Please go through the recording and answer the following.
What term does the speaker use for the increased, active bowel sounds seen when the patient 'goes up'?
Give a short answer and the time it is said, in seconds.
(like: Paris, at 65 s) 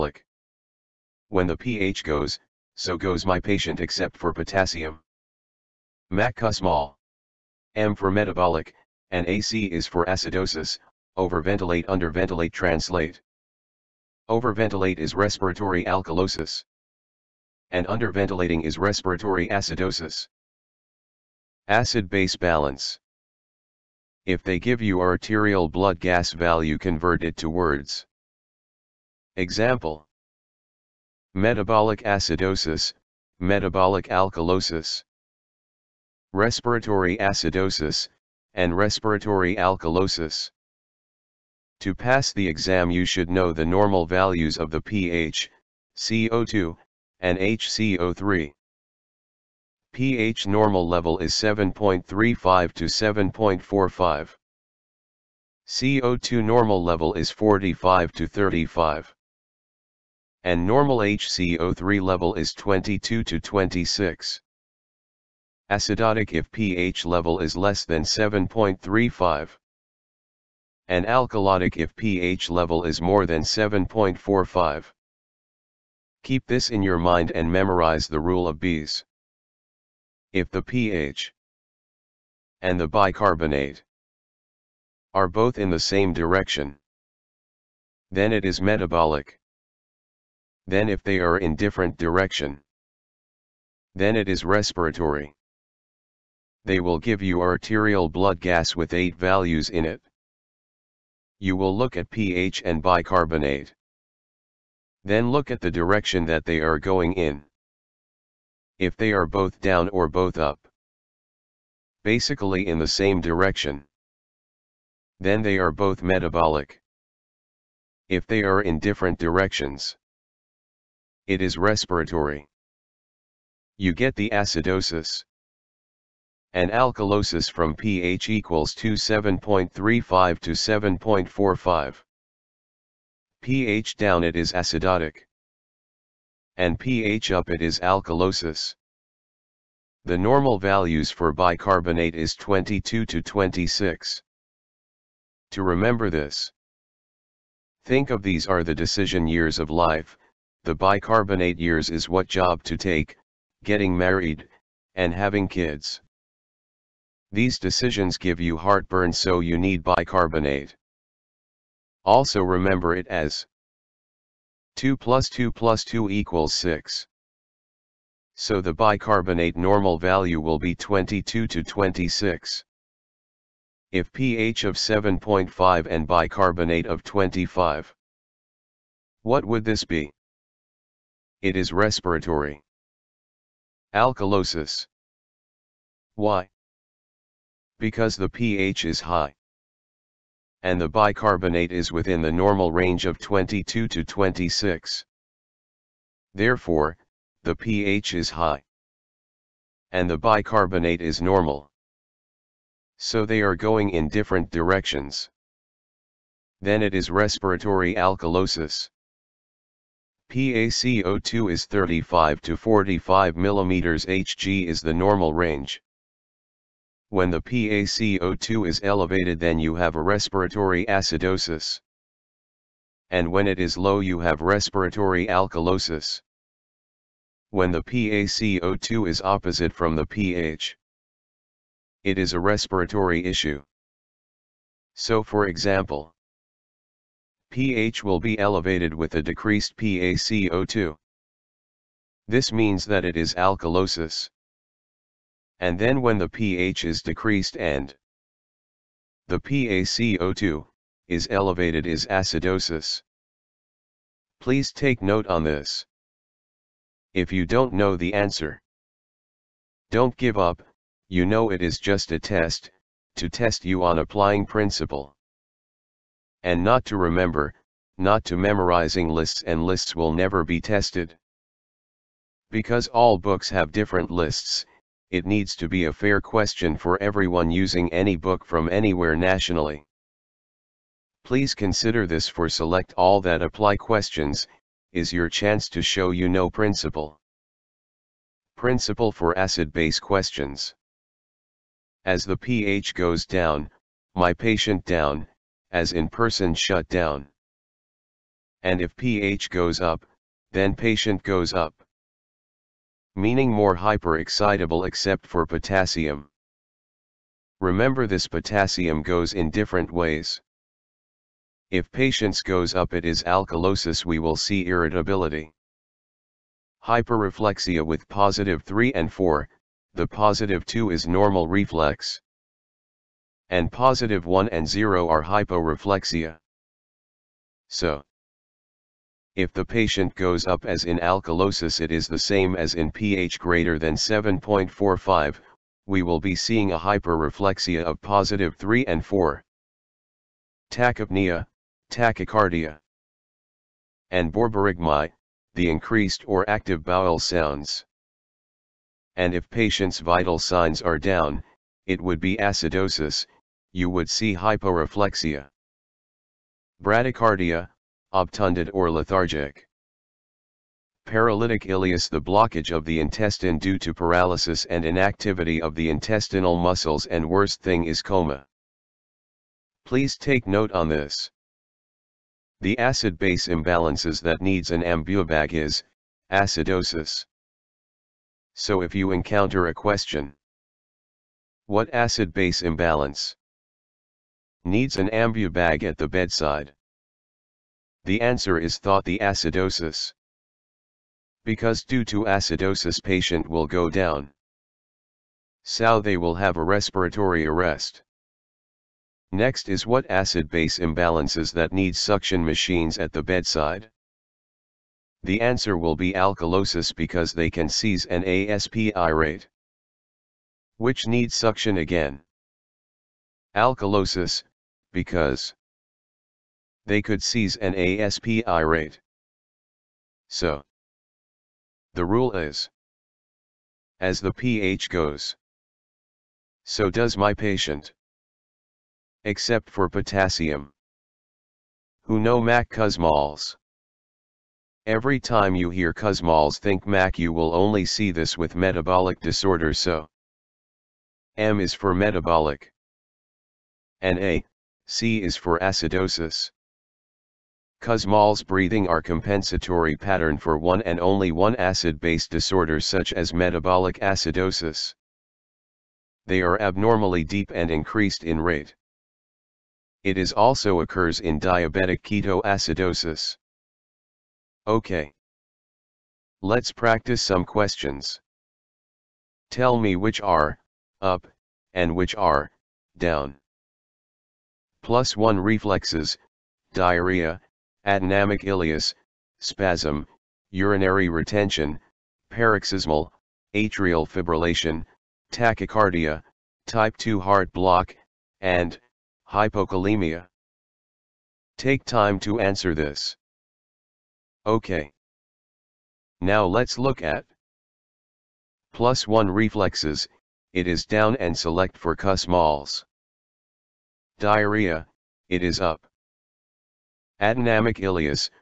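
borborygmi, at 344 s.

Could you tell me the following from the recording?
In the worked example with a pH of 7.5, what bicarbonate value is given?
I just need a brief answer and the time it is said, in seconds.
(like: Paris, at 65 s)
25, at 177 s.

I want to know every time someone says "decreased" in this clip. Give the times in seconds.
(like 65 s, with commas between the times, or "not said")
239 s, 247 s.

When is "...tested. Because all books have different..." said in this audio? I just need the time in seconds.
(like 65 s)
270 s.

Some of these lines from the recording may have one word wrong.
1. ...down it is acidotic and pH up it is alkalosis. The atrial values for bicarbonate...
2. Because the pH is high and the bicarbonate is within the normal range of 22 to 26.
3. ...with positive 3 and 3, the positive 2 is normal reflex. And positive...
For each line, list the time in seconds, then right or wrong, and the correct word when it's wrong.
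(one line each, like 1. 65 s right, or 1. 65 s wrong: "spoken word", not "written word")
1. 133 s wrong: "normal", not "atrial"
2. 187 s right
3. 317 s wrong: "4", not "3".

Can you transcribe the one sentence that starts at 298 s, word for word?
And if pH goes up, then patient goes up meaning more hyperexcitable except for potassium.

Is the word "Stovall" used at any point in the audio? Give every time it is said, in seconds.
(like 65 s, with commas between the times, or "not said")
not said.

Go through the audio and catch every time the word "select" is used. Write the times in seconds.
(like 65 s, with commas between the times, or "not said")
282 s, 501 s.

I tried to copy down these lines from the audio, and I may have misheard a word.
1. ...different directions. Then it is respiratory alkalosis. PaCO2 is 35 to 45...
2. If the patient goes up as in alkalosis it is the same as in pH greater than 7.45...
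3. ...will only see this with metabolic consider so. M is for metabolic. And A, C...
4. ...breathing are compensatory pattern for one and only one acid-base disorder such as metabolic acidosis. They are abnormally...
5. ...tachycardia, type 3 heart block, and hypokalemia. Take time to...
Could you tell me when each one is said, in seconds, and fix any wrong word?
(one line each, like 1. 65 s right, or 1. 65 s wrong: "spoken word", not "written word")
1. 204 s right
2. 329 s right
3. 437 s wrong: "disorder", not "consider"
4. 448 s right
5. 485 s wrong: "2", not "3".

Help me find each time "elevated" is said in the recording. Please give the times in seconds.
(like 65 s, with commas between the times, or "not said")
218 s, 238 s, 251 s.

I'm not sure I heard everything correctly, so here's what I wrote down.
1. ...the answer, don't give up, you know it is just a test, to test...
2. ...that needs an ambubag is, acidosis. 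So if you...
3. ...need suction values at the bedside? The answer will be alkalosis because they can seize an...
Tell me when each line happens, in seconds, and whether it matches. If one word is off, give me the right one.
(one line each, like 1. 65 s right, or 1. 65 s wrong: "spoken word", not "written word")
1. 257 s right
2. 374 s right
3. 401 s wrong: "machines", not "values".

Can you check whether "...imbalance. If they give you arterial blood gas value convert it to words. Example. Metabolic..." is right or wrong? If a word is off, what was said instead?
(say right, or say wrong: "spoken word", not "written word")
wrong: "balance", not "imbalance".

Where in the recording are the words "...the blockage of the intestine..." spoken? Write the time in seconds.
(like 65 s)
362 s.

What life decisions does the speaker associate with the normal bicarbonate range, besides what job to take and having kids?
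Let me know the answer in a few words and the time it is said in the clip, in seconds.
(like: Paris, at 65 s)
getting married, at 153 s.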